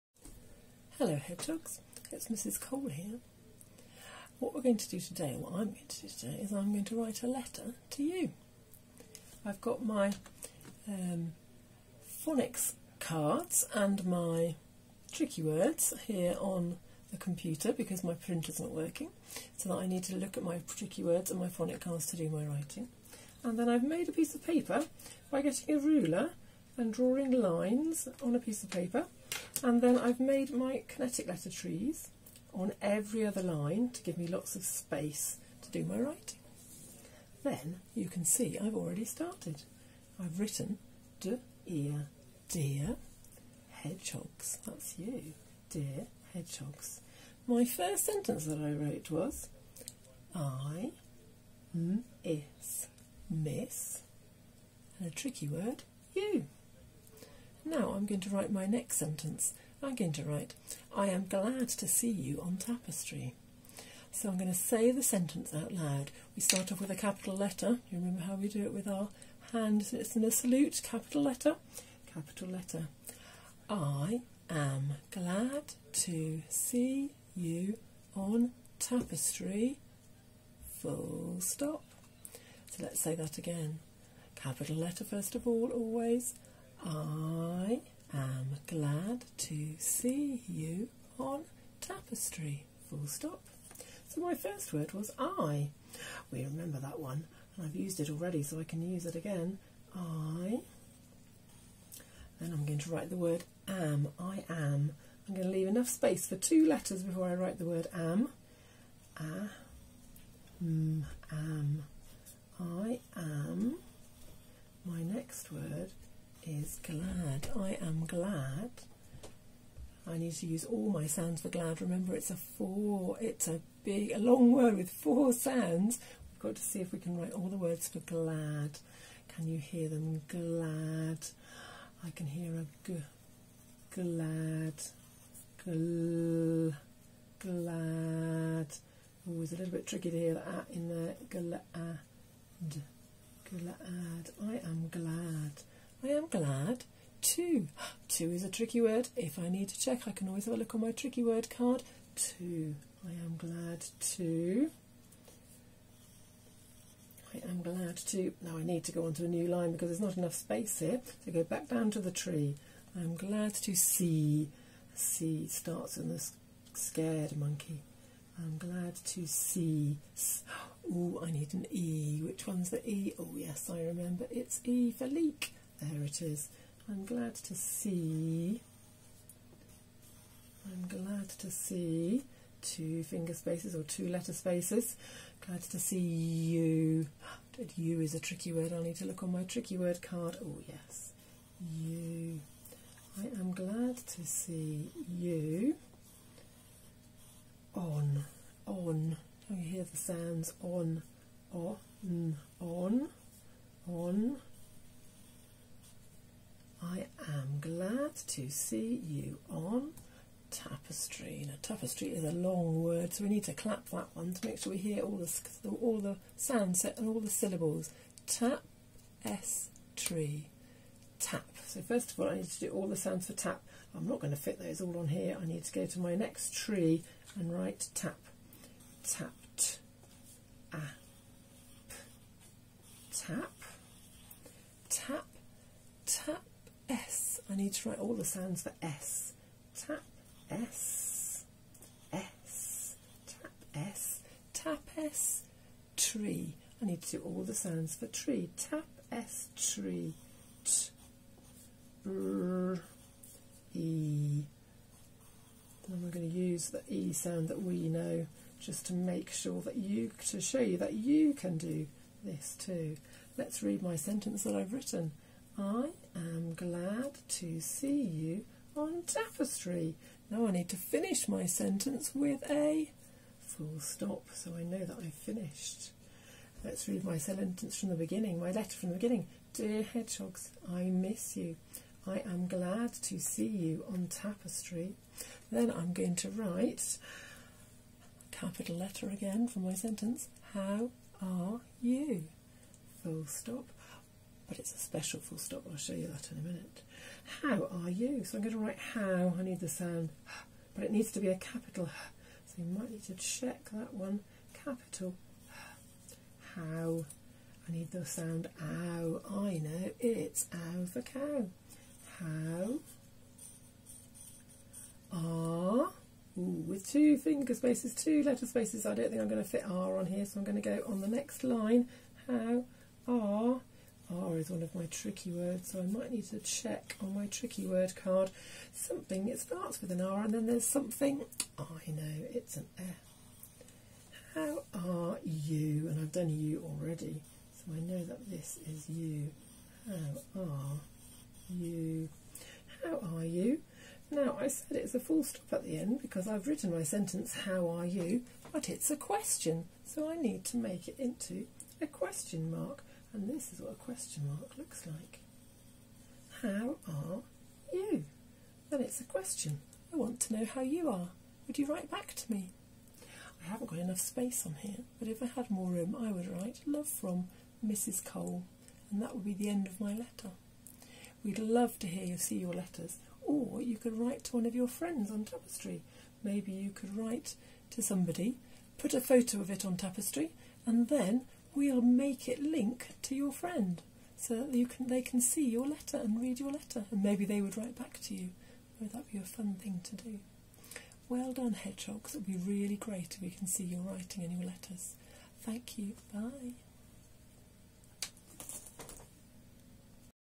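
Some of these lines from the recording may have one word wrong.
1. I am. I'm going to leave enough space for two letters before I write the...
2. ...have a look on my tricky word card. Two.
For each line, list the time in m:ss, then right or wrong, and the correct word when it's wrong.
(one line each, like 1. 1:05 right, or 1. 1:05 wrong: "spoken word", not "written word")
1. 1:44 right
2. 2:30 right.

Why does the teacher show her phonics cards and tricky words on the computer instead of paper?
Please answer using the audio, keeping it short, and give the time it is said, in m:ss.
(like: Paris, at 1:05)
printer's not working, at 0:18.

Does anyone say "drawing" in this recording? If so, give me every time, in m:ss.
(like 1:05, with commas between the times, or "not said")
0:26.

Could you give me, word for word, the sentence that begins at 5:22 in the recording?
How are R is one of my tricky words, so I might need to check on my tricky word card something.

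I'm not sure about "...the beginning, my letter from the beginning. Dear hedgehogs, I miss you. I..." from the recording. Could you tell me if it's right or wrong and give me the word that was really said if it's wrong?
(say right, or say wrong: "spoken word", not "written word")
right.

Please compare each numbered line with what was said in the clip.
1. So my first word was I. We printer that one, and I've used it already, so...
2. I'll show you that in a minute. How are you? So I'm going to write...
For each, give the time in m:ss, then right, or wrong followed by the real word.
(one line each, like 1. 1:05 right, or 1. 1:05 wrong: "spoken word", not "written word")
1. 1:34 wrong: "remember", not "printer"
2. 4:55 right.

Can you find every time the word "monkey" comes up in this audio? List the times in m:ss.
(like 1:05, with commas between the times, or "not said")
2:47.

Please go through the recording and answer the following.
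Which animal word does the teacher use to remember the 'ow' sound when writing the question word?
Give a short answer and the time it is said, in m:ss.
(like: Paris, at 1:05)
cow, at 5:10.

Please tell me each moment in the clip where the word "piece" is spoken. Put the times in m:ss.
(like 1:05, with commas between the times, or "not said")
0:24, 0:28.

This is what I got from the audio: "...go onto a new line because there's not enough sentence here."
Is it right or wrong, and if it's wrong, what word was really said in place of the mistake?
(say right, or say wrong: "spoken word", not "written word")
wrong: "space", not "sentence".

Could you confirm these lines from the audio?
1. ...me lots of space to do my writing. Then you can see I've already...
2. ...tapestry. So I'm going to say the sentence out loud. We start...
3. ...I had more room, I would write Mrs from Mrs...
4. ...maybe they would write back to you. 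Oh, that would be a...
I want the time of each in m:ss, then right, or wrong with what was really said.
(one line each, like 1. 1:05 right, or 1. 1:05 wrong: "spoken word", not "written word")
1. 0:34 right
2. 1:02 right
3. 6:05 wrong: "Love", not "Mrs"
4. 6:27 right.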